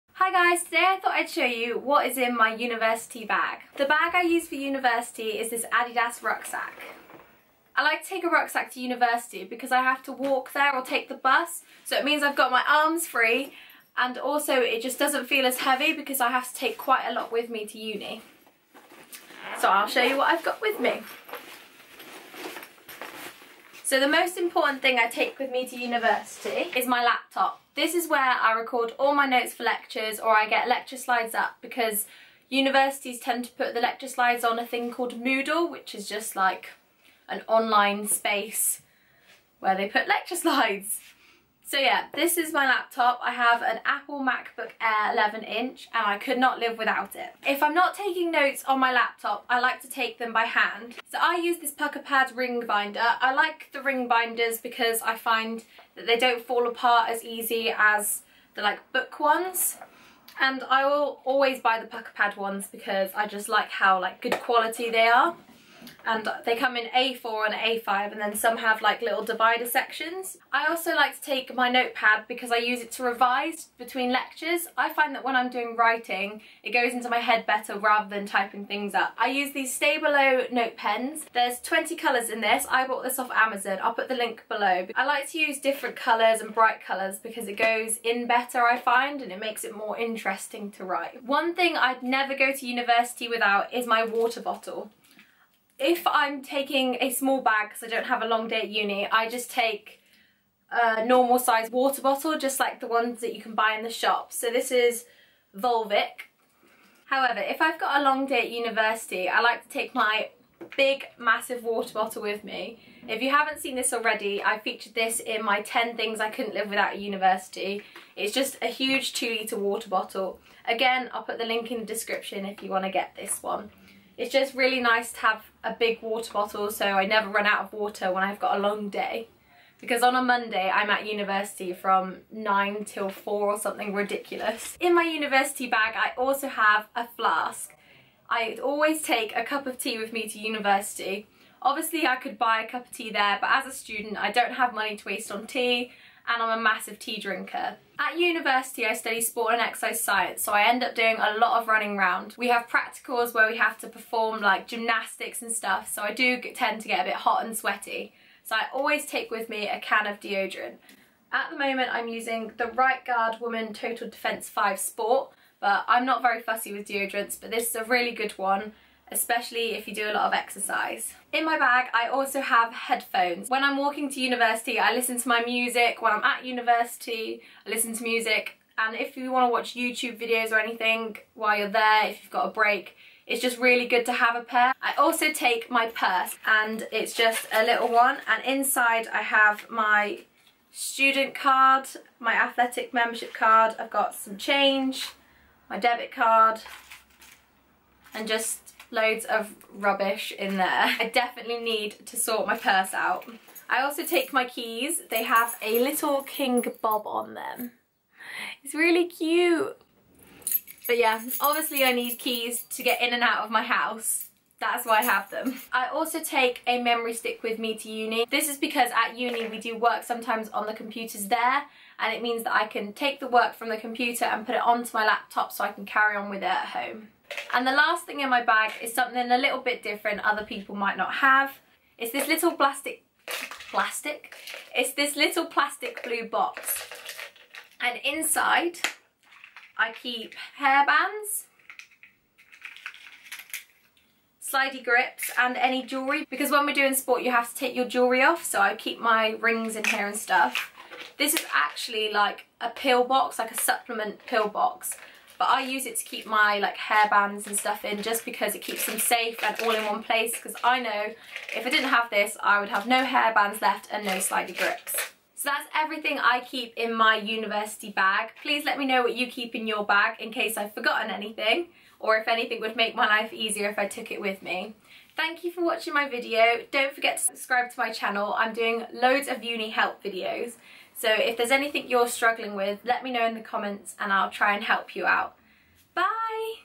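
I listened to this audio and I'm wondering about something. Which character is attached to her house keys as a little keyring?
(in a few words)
King Bob.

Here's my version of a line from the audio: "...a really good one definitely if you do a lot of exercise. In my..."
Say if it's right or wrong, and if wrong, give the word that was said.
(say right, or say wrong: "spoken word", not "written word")
wrong: "especially", not "definitely".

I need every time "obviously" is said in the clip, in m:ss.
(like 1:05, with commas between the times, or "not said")
2:21, 3:31.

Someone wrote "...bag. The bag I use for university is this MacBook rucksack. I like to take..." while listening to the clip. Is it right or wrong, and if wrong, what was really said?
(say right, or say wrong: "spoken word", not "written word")
wrong: "Adidas", not "MacBook".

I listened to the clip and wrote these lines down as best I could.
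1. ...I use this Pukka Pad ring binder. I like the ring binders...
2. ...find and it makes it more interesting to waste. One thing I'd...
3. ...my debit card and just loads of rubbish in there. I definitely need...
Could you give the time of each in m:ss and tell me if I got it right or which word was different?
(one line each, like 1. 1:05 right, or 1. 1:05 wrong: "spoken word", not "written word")
1. 0:51 right
2. 1:28 wrong: "write", not "waste"
3. 3:15 right.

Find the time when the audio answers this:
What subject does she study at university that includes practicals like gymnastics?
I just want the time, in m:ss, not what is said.
2:29.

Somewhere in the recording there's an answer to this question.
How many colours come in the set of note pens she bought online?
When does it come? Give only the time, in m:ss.
1:21.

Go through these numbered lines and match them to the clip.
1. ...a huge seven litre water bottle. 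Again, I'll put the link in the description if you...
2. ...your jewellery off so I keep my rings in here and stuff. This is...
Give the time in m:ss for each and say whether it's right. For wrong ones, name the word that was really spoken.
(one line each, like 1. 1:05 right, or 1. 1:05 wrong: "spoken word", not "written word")
1. 1:58 wrong: "two", not "seven"
2. 4:07 right.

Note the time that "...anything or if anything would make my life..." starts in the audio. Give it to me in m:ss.
4:31.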